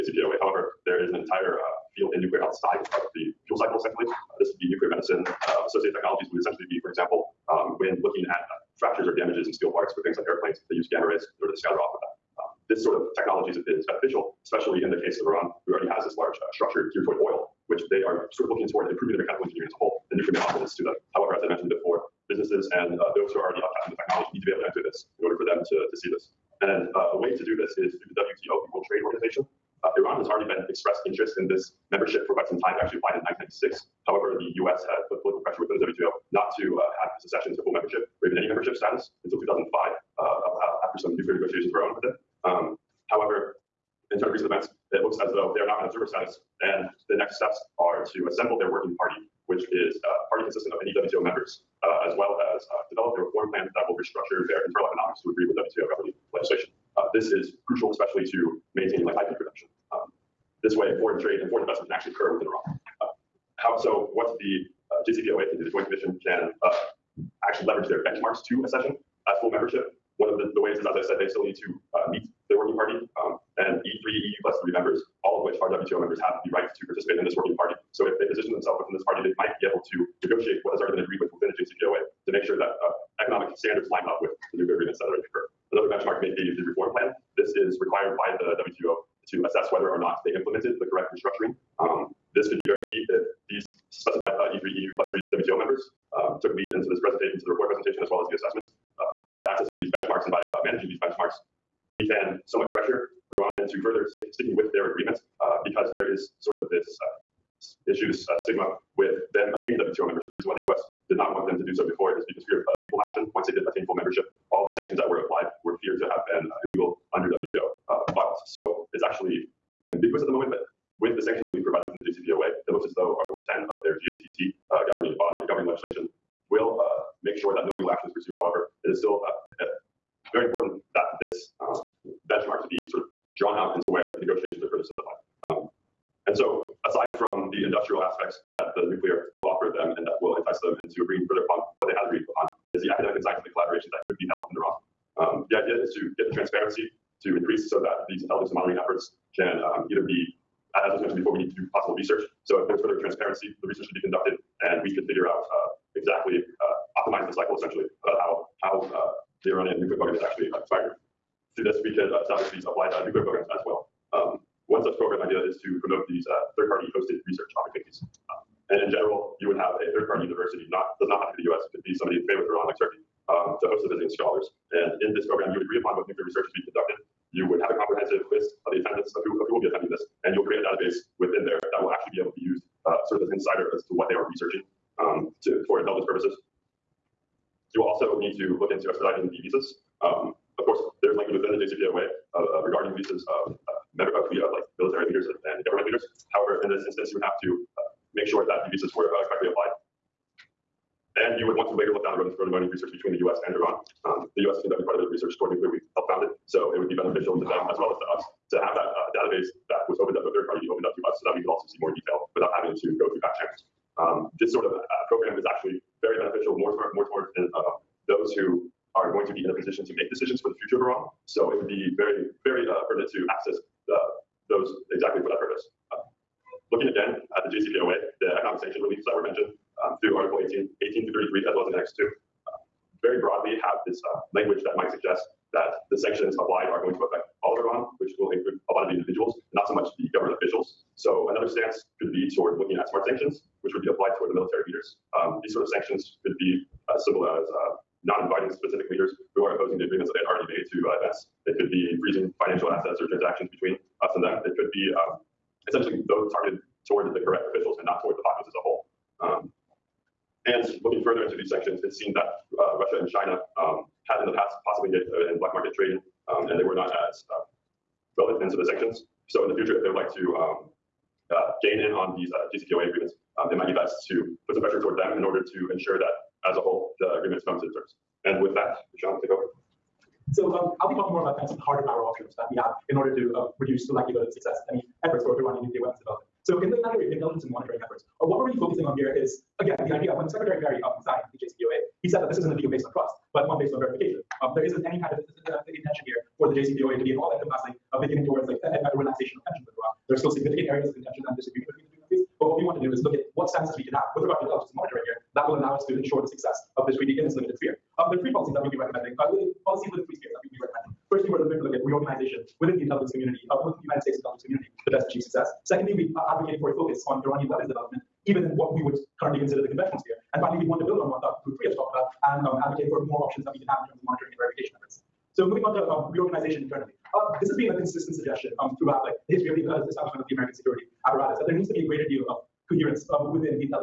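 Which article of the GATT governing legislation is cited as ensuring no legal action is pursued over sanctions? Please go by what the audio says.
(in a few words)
Article 10.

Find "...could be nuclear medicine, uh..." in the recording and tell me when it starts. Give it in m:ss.
0:04.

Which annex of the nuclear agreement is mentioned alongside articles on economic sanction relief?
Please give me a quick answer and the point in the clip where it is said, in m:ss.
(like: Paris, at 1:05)
Annex 2, at 3:51.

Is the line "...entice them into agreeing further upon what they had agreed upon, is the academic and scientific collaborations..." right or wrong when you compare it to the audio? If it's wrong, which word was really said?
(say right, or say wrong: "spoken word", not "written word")
right.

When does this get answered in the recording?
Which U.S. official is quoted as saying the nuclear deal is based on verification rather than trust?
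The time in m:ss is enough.
4:50.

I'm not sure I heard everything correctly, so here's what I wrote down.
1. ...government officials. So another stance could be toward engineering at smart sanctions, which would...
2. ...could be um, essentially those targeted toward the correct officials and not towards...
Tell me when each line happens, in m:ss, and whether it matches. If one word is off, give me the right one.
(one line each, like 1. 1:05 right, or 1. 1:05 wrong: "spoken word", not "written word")
1. 4:00 wrong: "looking", not "engineering"
2. 4:14 right.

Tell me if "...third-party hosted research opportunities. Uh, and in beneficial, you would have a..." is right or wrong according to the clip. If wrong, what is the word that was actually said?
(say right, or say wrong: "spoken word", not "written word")
wrong: "general", not "beneficial".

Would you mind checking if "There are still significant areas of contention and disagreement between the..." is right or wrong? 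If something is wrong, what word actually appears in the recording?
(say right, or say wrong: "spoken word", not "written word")
right.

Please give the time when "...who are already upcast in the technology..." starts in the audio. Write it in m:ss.
0:23.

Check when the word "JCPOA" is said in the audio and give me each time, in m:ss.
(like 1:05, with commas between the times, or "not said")
1:05, 1:21, 2:02, 3:11, 3:47, 4:32, 4:51, 4:56.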